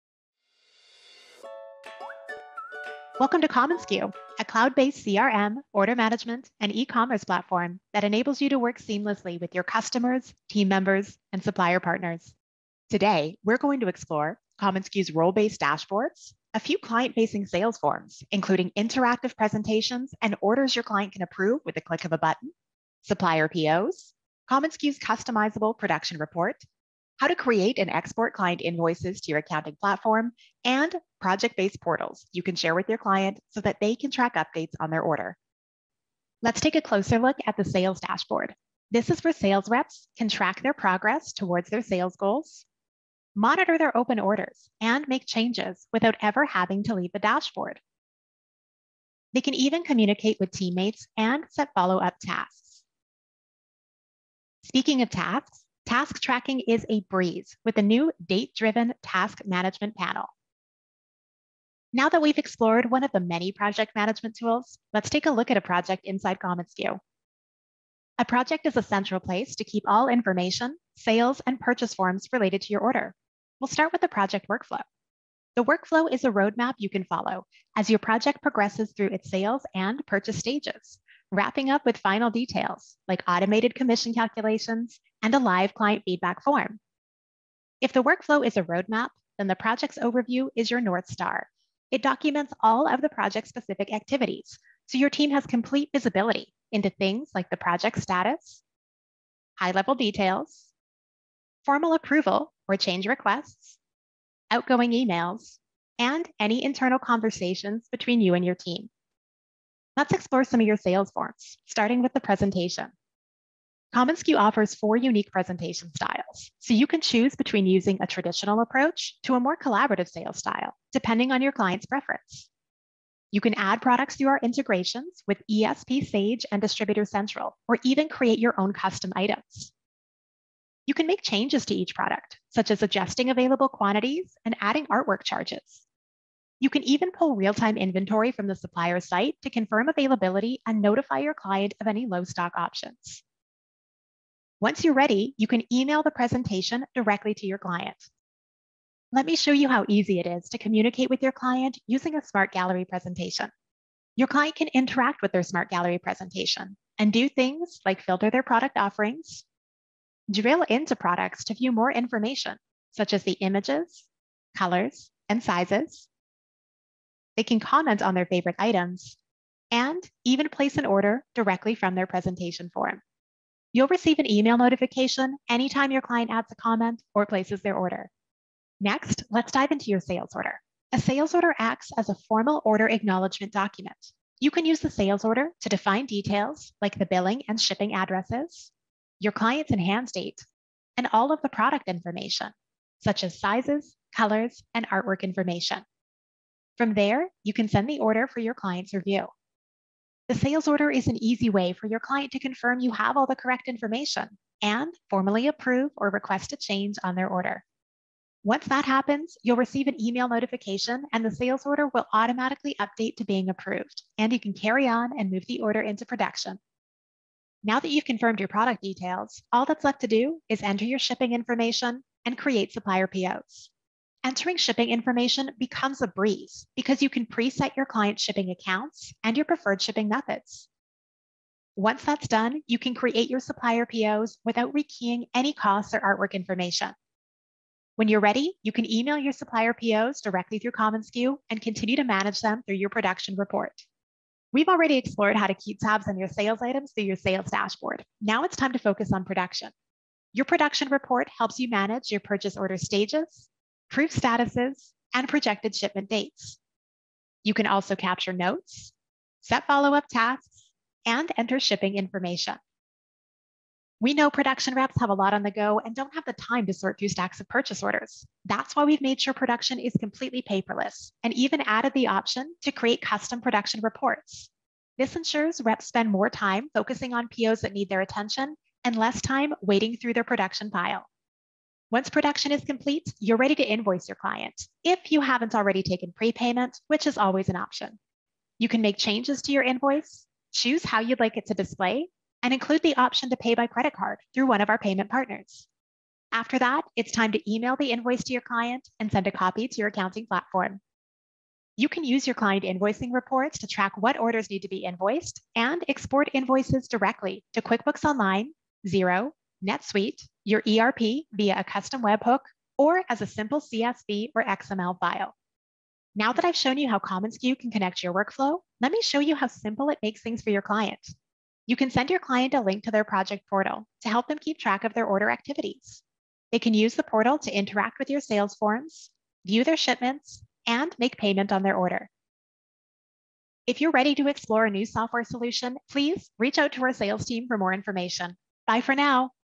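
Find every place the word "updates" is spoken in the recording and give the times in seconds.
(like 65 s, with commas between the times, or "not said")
34 s, 212 s.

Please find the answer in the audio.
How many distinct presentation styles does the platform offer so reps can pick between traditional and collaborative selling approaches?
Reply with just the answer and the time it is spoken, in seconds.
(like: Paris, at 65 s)
4, at 114 s.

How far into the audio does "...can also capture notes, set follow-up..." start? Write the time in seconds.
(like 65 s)
257 s.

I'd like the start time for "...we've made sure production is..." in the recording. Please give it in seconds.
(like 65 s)
268 s.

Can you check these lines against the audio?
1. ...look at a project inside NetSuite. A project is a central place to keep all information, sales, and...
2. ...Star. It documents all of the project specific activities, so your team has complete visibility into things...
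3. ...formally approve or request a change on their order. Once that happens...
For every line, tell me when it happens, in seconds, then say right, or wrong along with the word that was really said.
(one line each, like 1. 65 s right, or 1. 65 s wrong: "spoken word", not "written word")
1. 65 s wrong: "View", not "NetSuite"
2. 91 s right
3. 205 s right.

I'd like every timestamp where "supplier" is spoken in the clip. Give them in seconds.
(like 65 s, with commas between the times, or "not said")
11 s, 23 s, 138 s, 222 s, 233 s, 239 s.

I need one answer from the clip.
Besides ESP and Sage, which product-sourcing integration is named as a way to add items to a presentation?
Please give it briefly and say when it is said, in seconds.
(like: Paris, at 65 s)
Distributor Central, at 126 s.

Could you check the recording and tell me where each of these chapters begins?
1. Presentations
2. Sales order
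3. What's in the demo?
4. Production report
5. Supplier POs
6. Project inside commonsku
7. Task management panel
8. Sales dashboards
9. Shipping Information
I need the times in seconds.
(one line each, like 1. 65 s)
1. 109 s
2. 178 s
3. 12 s
4. 248 s
5. 230 s
6. 67 s
7. 53 s
8. 36 s
9. 217 s.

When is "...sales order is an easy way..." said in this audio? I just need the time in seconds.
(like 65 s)
200 s.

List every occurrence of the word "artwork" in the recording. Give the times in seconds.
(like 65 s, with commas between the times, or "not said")
134 s, 194 s, 235 s.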